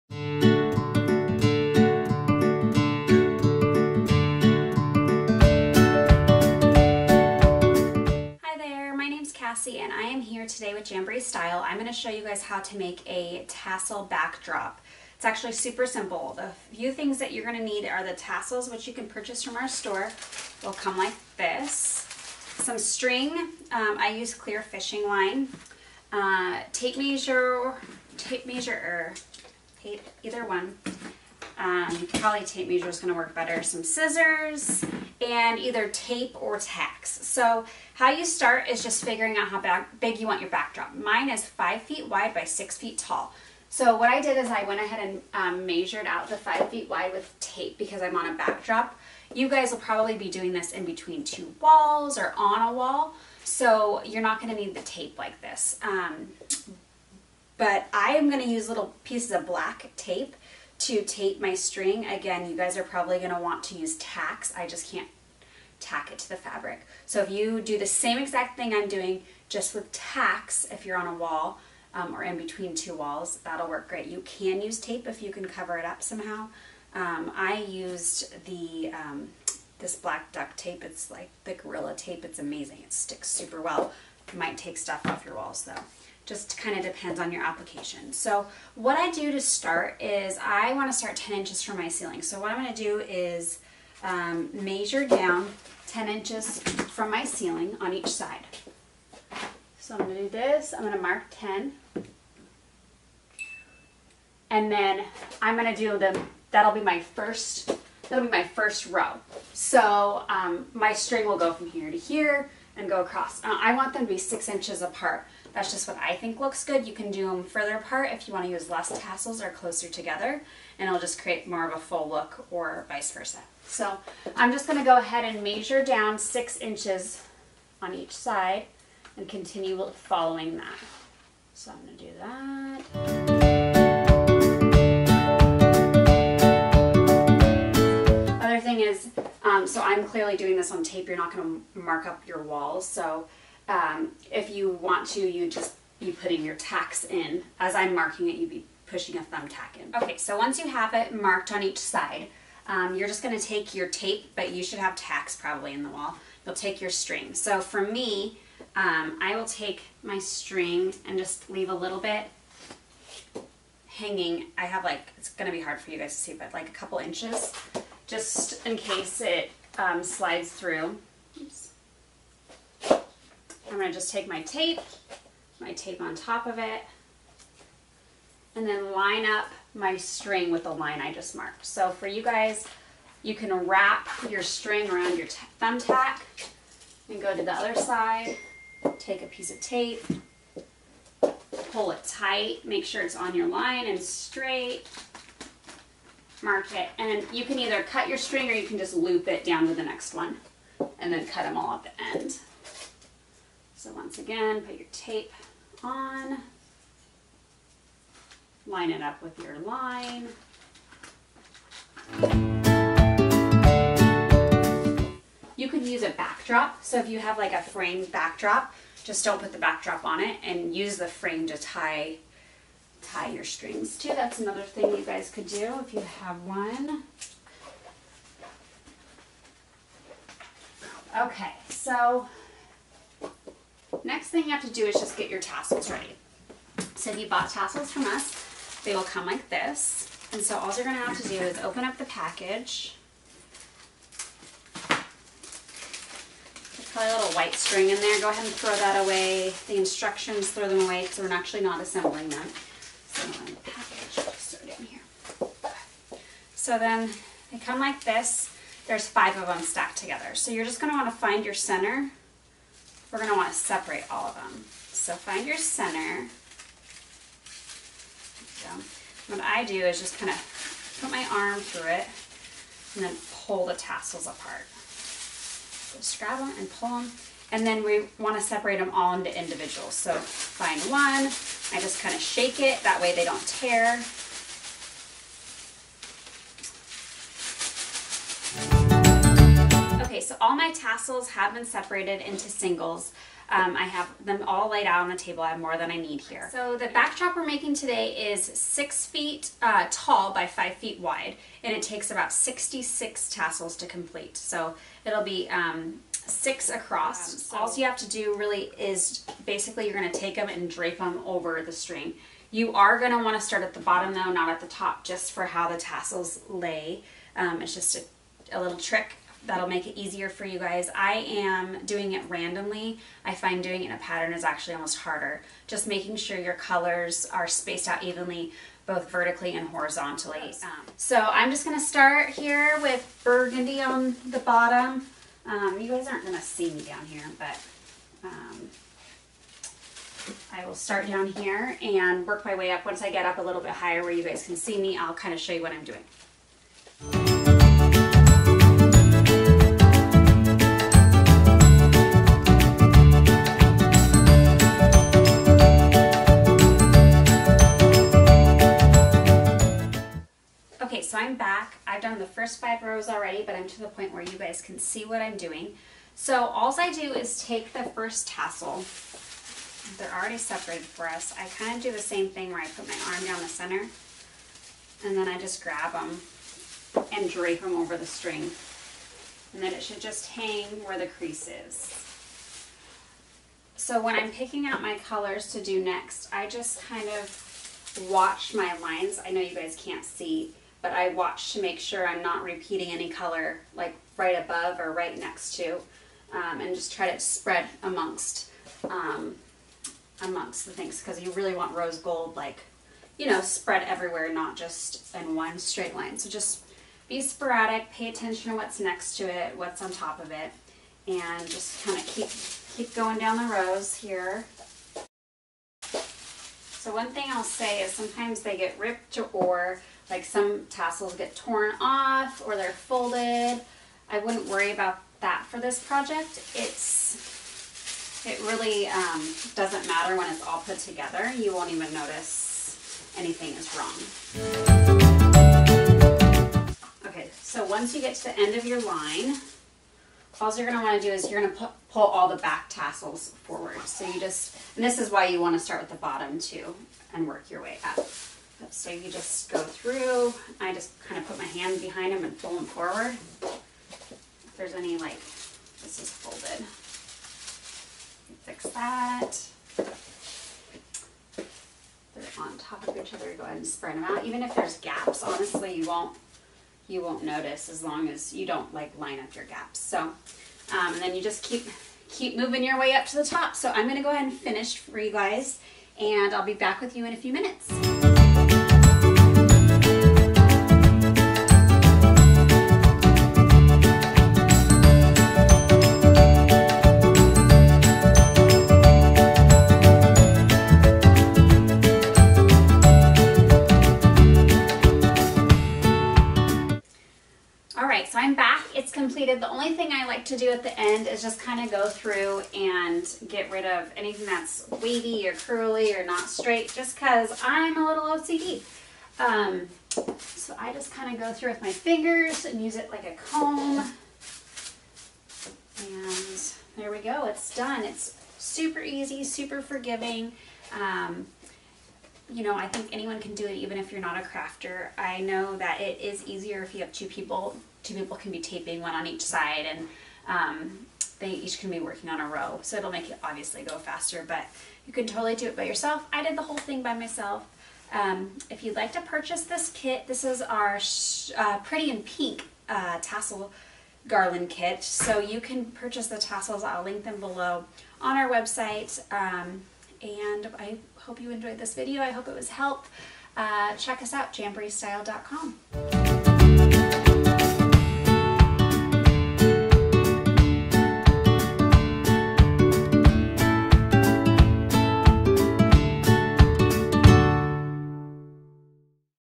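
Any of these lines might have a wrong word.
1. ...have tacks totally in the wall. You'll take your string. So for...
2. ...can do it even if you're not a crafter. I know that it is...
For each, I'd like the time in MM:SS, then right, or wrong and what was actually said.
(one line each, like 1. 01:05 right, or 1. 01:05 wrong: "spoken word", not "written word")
1. 02:34 wrong: "probably", not "totally"
2. 08:43 right.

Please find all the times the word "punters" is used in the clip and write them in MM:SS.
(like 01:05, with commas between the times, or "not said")
not said.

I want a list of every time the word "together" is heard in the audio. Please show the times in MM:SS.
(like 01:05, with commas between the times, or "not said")
01:59, 04:19, 07:10.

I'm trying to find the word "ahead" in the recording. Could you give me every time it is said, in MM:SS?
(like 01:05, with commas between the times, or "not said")
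00:44, 02:04, 04:08, 07:43, 07:54.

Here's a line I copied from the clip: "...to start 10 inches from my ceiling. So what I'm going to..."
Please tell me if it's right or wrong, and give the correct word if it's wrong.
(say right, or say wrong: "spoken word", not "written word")
right.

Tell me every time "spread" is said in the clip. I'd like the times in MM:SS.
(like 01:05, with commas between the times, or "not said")
06:37, 06:43, 07:43.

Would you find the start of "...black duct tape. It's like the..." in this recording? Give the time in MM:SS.
01:19.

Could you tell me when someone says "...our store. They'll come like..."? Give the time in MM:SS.
00:19.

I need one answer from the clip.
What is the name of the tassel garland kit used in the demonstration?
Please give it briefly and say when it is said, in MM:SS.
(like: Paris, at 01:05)
Pretty in Pink, at 09:01.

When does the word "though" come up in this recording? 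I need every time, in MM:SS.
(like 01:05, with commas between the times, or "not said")
01:25, 05:14.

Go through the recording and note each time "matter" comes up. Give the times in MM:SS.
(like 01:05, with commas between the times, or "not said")
07:09.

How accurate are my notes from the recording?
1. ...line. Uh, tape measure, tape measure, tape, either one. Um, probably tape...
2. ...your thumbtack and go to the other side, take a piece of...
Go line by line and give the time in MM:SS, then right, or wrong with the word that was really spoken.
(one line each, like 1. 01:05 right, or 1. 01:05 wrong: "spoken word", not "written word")
1. 00:25 right
2. 03:05 right.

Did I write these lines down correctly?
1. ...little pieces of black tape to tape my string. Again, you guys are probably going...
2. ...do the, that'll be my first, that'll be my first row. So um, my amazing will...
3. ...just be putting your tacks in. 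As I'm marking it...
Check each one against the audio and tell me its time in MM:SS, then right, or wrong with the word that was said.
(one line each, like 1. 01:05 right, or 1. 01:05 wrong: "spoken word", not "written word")
1. 00:58 right
2. 01:45 wrong: "string", not "amazing"
3. 02:25 right.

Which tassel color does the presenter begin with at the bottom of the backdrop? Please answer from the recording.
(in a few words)
Burgundy.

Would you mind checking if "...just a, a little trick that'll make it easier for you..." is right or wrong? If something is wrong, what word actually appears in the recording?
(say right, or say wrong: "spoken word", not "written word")
right.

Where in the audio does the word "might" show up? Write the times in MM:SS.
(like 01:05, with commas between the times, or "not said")
01:24.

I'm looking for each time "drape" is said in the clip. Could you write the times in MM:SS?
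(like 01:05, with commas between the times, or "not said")
05:10, 06:17.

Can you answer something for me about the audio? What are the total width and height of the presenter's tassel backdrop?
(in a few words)
5 feet wide by 6 feet tall.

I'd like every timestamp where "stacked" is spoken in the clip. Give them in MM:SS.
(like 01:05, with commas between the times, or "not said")
04:19.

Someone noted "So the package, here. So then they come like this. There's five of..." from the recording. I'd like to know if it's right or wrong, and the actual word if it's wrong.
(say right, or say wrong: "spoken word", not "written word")
right.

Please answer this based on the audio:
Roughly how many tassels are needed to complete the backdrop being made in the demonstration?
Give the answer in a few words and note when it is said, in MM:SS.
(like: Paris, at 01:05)
66, at 05:02.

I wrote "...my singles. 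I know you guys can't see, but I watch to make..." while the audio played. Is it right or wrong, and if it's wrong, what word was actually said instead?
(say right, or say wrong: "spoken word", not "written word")
wrong: "lines", not "singles".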